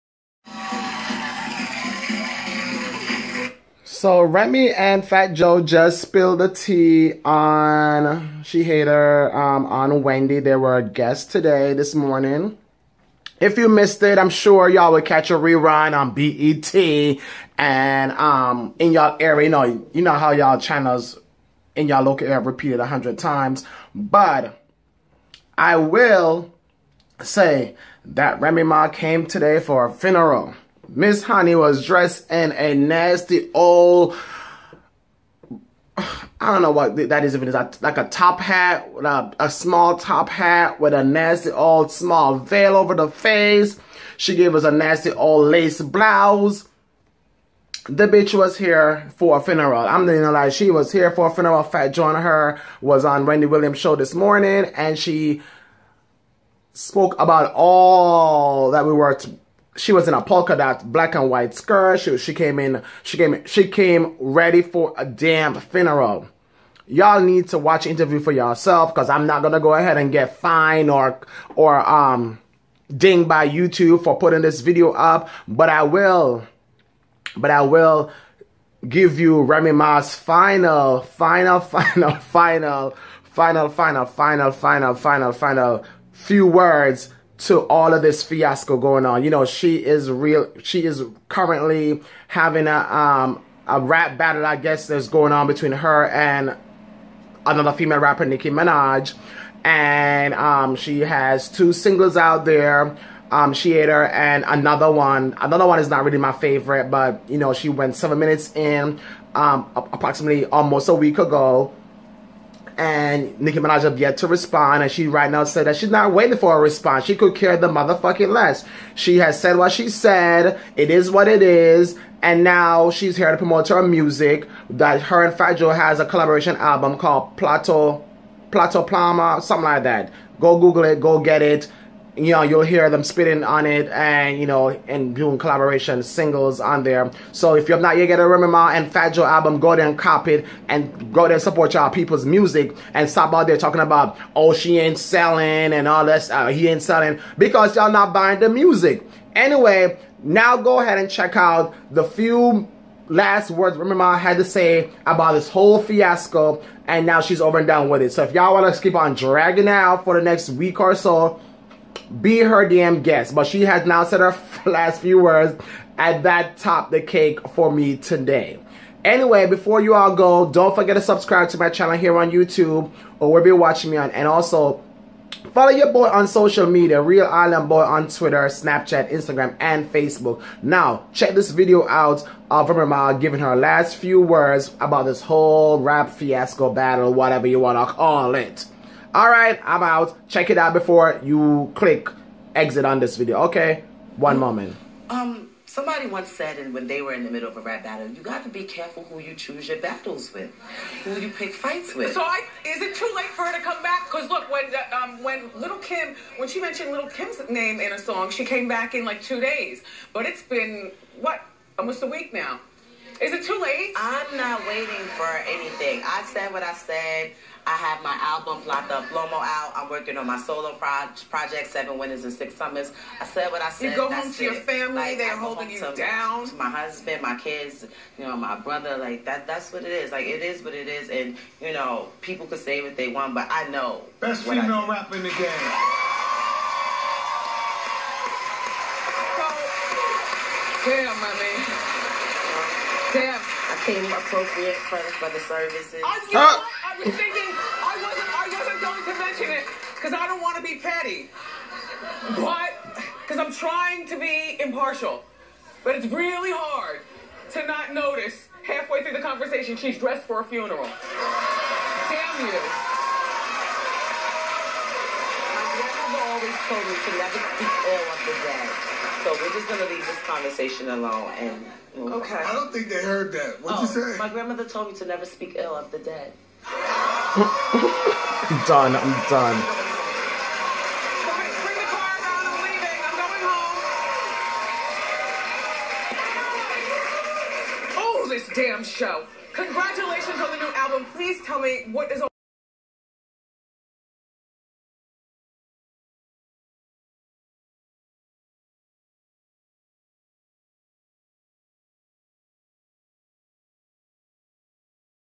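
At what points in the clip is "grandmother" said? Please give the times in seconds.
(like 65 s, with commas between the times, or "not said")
265 s, 274 s.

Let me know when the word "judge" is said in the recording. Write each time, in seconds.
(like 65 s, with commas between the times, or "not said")
not said.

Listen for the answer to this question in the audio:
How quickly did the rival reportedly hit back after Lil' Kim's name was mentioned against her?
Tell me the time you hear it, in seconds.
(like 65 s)
209 s.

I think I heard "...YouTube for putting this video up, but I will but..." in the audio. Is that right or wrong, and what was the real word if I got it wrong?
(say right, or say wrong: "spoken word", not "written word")
right.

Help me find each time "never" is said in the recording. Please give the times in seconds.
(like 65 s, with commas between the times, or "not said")
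267 s, 275 s.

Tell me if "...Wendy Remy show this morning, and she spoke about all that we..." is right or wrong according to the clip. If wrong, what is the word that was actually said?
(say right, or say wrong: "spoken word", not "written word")
wrong: "Williams", not "Remy".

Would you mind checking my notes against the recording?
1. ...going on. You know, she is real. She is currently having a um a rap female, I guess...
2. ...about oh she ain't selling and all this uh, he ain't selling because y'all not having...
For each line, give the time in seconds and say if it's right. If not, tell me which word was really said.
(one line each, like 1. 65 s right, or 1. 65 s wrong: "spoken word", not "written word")
1. 88 s wrong: "battle", not "female"
2. 143 s wrong: "buying", not "having".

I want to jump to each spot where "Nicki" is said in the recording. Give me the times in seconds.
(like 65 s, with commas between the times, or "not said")
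98 s, 113 s.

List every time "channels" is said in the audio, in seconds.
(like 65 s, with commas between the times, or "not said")
20 s, 171 s.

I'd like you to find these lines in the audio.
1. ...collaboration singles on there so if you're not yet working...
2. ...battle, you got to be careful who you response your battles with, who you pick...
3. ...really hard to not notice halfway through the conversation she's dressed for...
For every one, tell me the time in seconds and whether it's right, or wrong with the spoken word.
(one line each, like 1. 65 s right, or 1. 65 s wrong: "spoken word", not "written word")
1. 135 s wrong: "getting", not "working"
2. 197 s wrong: "choose", not "response"
3. 256 s right.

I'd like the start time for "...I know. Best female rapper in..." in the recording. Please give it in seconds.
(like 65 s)
233 s.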